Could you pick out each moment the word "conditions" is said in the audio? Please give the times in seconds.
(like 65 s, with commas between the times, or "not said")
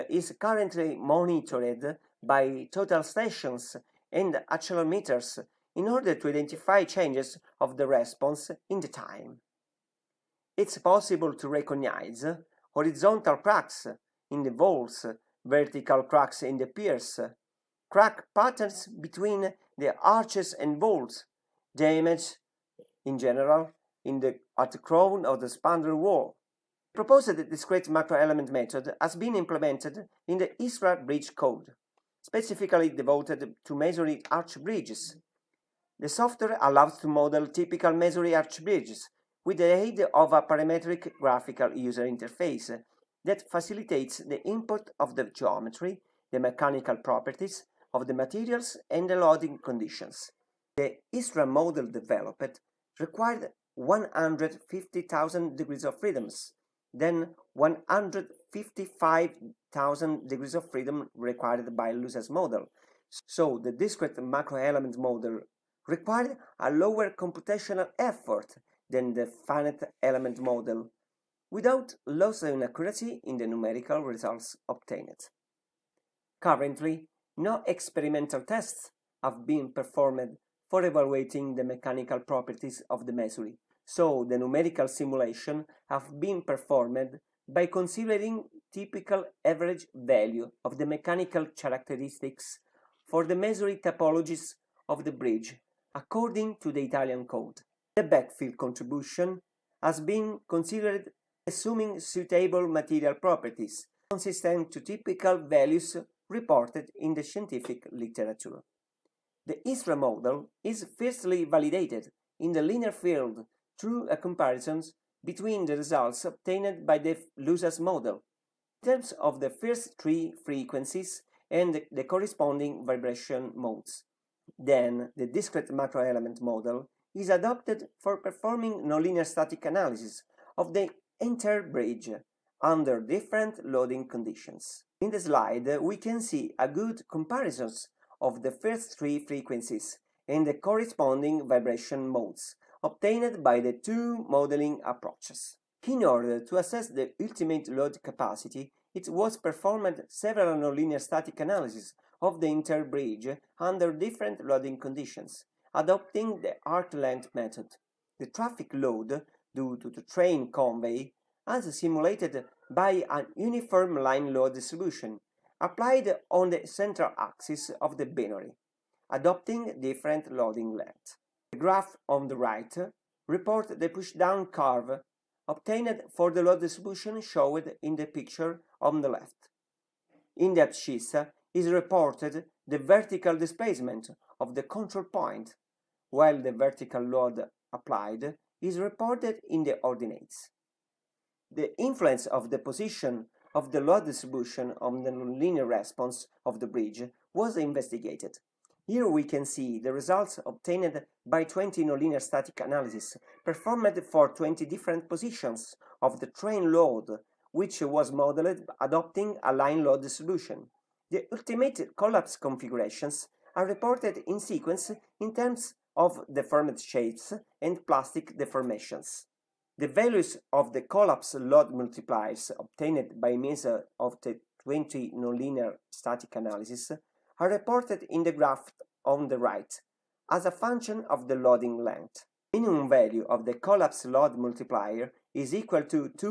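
49 s, 134 s, 154 s.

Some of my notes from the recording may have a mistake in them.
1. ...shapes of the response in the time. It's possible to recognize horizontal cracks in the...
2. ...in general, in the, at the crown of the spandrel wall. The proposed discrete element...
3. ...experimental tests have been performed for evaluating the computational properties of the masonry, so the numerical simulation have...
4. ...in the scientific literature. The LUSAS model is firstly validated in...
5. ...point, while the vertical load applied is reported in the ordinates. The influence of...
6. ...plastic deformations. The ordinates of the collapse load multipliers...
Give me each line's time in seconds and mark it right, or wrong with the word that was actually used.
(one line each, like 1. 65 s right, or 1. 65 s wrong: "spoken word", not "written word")
1. 6 s wrong: "changes", not "shapes"
2. 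23 s wrong: "macroelement", not "element"
3. 77 s wrong: "mechanical", not "computational"
4. 106 s wrong: "HiStrA", not "LUSAS"
5. 185 s right
6. 217 s wrong: "values", not "ordinates".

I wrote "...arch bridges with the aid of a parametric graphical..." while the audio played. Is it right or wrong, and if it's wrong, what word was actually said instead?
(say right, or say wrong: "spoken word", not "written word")
right.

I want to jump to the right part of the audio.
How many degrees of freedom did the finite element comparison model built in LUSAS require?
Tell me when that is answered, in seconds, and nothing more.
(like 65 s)
57 s.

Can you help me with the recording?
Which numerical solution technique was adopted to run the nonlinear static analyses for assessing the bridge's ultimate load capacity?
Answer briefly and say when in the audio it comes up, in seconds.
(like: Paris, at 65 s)
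Arc length method, at 156 s.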